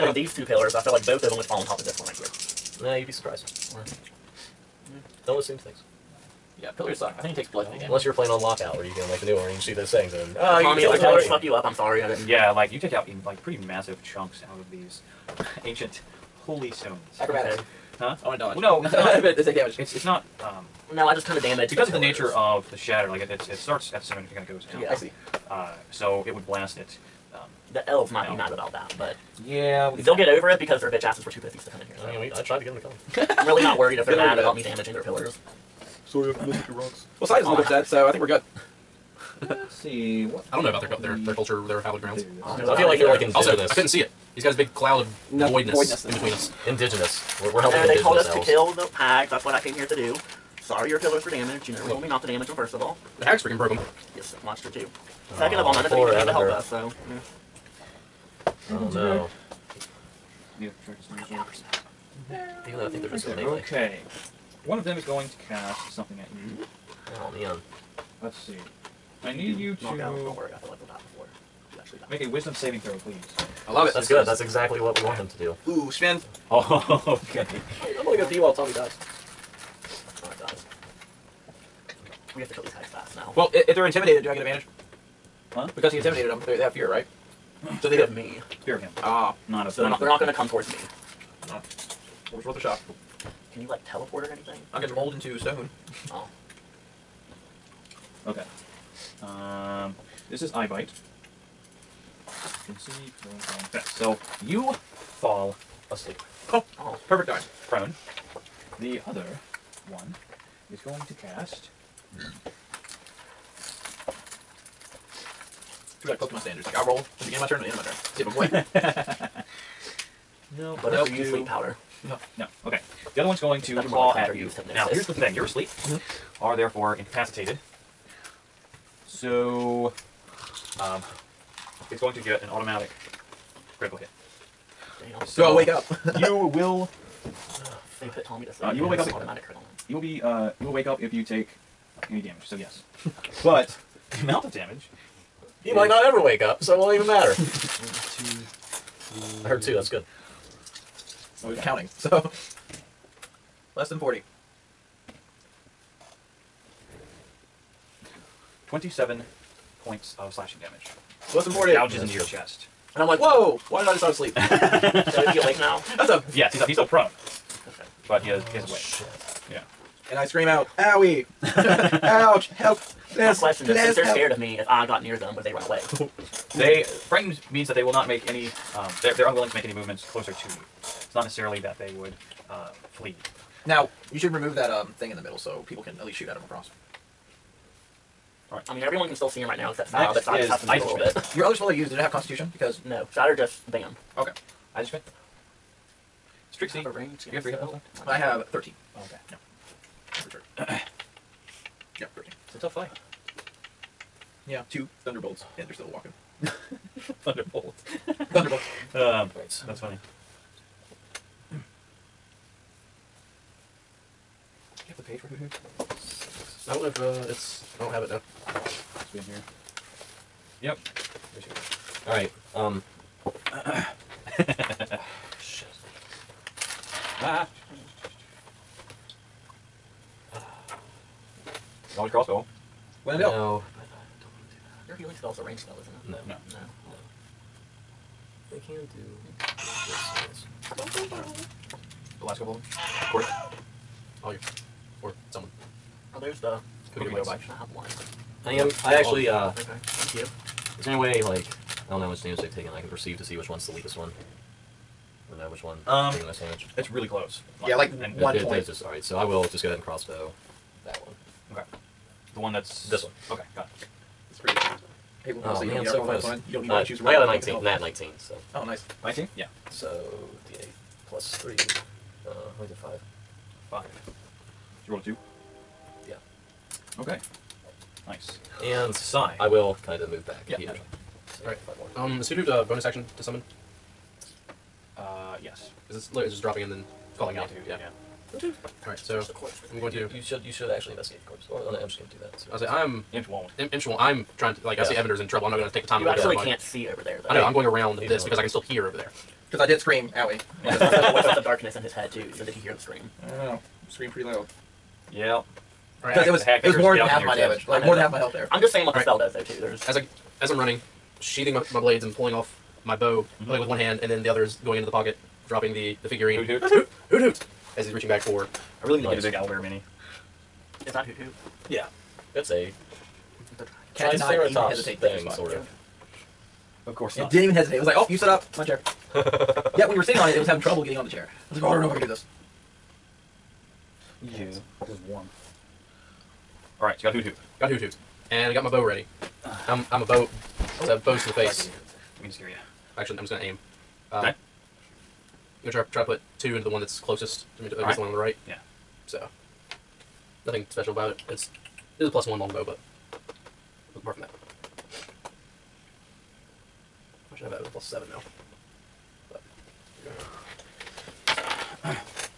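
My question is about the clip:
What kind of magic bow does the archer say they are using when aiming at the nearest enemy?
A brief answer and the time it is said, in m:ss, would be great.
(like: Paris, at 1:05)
Plus one longbow, at 5:52.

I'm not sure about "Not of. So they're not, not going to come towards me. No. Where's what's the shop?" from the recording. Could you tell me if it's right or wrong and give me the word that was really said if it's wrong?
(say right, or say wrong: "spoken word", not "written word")
right.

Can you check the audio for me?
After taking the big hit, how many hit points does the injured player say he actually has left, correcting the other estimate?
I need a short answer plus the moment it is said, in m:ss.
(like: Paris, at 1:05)
13, at 3:18.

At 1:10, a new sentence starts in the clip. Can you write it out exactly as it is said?
Don't worry, I feel like they'll die before you actually die.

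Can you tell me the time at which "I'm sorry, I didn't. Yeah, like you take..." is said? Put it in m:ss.
0:11.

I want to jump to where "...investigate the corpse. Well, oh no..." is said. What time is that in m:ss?
4:50.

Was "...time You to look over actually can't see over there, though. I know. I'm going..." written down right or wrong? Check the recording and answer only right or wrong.
right.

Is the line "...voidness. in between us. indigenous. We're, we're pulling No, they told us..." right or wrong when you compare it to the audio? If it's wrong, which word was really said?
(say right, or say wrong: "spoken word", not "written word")
wrong: "helping", not "pulling".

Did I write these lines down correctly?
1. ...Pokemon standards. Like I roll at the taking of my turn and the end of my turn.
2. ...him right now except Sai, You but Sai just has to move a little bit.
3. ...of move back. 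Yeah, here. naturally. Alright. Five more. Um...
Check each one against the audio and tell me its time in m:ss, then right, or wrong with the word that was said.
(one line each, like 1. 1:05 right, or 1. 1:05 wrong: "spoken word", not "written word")
1. 1:56 wrong: "beginning", not "taking"
2. 3:09 wrong: "Next", not "You"
3. 4:39 right.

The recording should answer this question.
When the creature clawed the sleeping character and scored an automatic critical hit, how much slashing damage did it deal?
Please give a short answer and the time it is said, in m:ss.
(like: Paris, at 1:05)
27, at 2:38.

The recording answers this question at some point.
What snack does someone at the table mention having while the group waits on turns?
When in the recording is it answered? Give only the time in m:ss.
4:06.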